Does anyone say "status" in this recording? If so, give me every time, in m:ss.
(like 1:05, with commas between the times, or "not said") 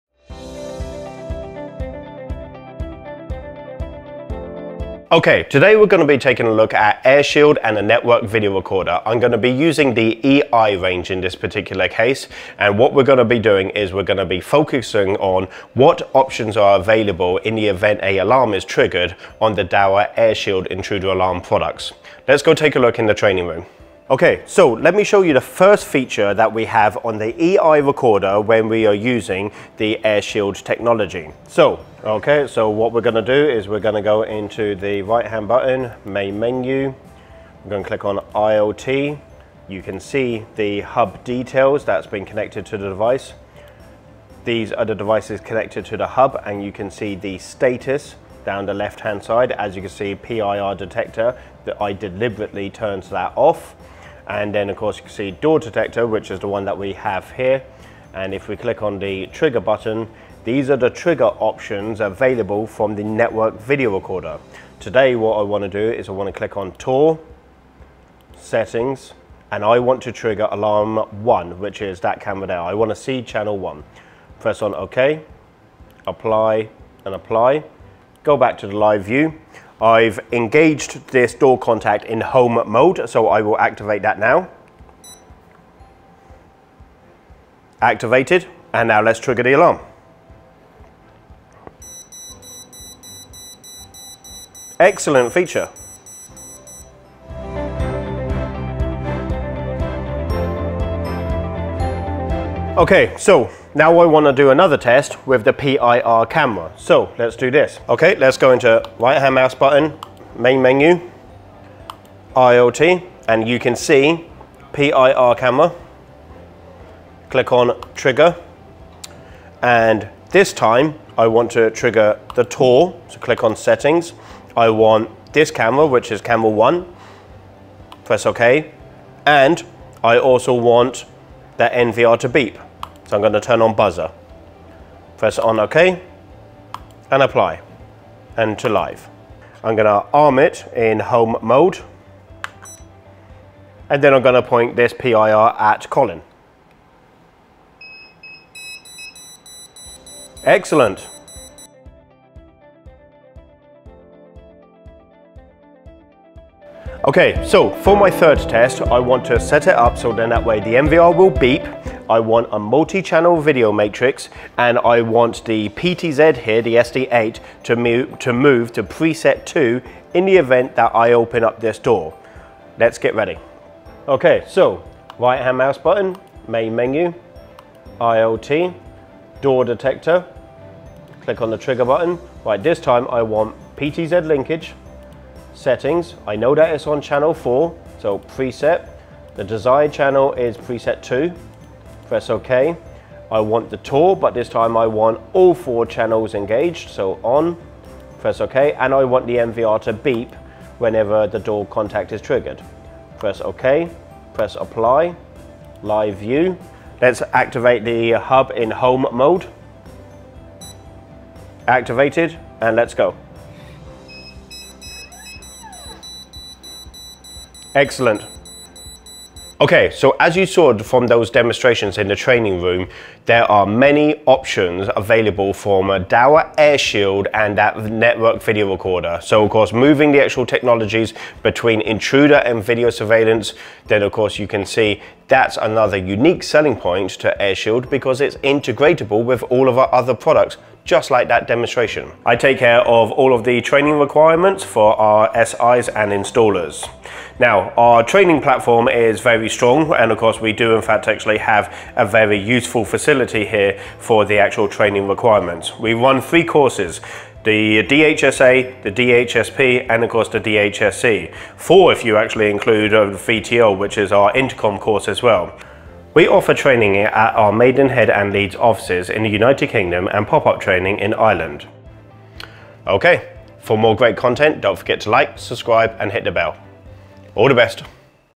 0:47.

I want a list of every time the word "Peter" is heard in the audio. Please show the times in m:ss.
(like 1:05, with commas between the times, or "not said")
not said.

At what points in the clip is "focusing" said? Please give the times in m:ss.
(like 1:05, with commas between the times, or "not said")
0:14.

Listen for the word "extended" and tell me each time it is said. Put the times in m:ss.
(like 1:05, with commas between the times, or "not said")
not said.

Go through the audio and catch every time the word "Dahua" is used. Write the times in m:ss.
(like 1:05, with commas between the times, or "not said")
0:19, 3:46.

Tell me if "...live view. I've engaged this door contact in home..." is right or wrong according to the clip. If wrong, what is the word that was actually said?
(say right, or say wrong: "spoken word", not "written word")
right.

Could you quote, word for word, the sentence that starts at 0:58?
And if we click on the trigger button, these are the trigger options available from the network video recorder.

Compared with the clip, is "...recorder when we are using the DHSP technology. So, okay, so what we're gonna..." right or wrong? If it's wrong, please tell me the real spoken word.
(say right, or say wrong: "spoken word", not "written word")
wrong: "AirShield", not "DHSP".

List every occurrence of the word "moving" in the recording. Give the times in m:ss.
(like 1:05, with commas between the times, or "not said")
3:49.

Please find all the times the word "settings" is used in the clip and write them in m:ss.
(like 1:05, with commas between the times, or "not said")
1:08, 2:03, 3:05.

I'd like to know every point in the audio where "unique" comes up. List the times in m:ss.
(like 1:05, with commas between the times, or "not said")
3:55.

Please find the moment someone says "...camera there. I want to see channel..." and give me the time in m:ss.
1:12.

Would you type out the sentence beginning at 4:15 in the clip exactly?
We run three courses the DHSA, the DHSP, and of course the DHSC.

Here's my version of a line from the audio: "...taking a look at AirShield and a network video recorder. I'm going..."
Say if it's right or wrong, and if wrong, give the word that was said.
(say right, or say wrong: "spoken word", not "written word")
right.